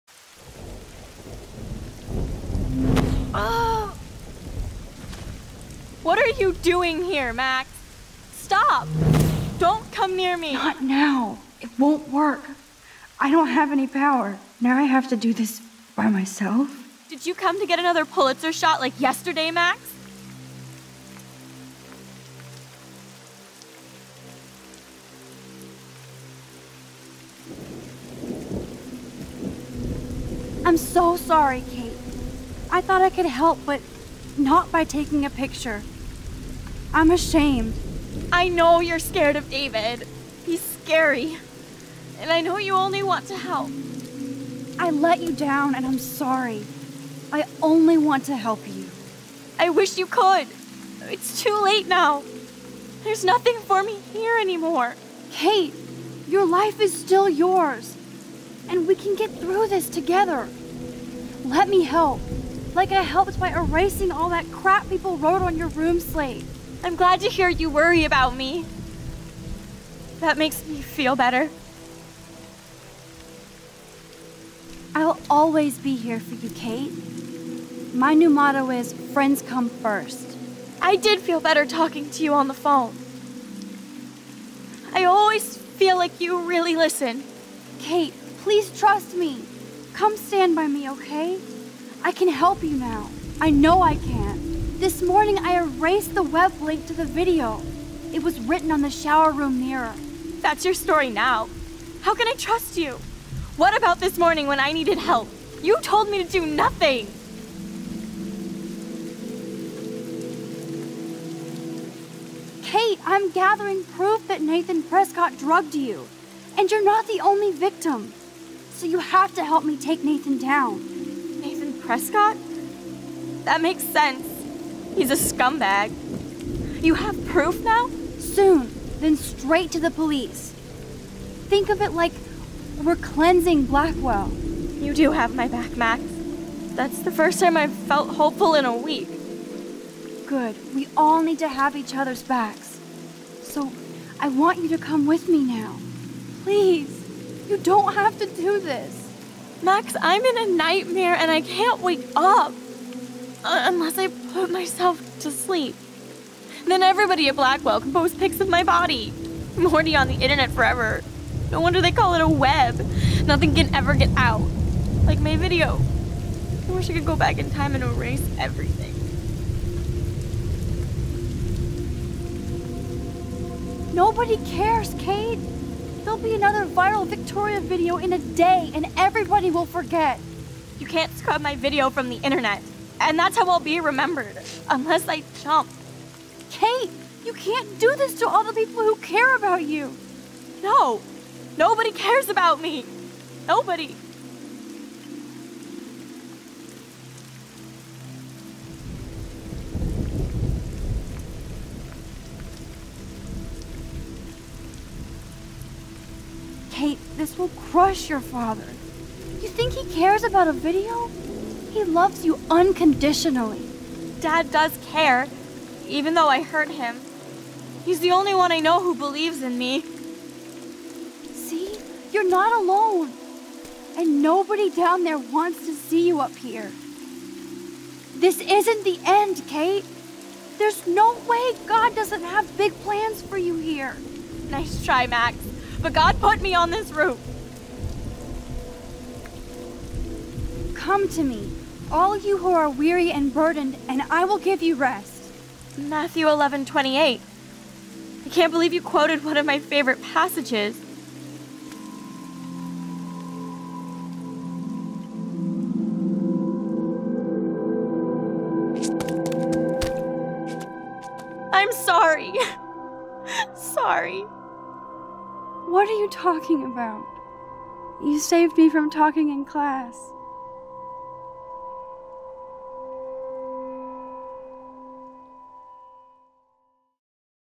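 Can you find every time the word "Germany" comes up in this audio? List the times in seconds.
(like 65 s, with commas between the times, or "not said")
not said.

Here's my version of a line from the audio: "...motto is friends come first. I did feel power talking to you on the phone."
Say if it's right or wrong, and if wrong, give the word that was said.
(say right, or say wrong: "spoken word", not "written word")
wrong: "better", not "power".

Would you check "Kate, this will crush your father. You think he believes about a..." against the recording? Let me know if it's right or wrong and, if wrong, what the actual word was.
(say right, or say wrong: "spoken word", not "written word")
wrong: "cares", not "believes".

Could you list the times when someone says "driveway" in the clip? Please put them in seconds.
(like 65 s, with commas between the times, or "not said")
not said.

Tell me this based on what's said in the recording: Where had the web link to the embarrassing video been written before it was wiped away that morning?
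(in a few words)
shower room mirror.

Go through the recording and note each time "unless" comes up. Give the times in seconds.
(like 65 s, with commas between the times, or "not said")
153 s, 184 s.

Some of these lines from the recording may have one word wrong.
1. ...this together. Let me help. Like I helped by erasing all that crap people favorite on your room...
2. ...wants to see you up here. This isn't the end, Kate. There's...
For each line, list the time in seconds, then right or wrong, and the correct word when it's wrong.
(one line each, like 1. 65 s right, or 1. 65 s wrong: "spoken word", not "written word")
1. 59 s wrong: "wrote", not "favorite"
2. 225 s right.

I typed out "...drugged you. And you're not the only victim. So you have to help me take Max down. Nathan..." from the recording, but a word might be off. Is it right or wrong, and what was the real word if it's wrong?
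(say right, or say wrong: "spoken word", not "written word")
wrong: "Nathan", not "Max".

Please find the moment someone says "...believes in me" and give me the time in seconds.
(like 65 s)
218 s.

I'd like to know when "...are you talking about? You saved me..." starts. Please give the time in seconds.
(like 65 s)
265 s.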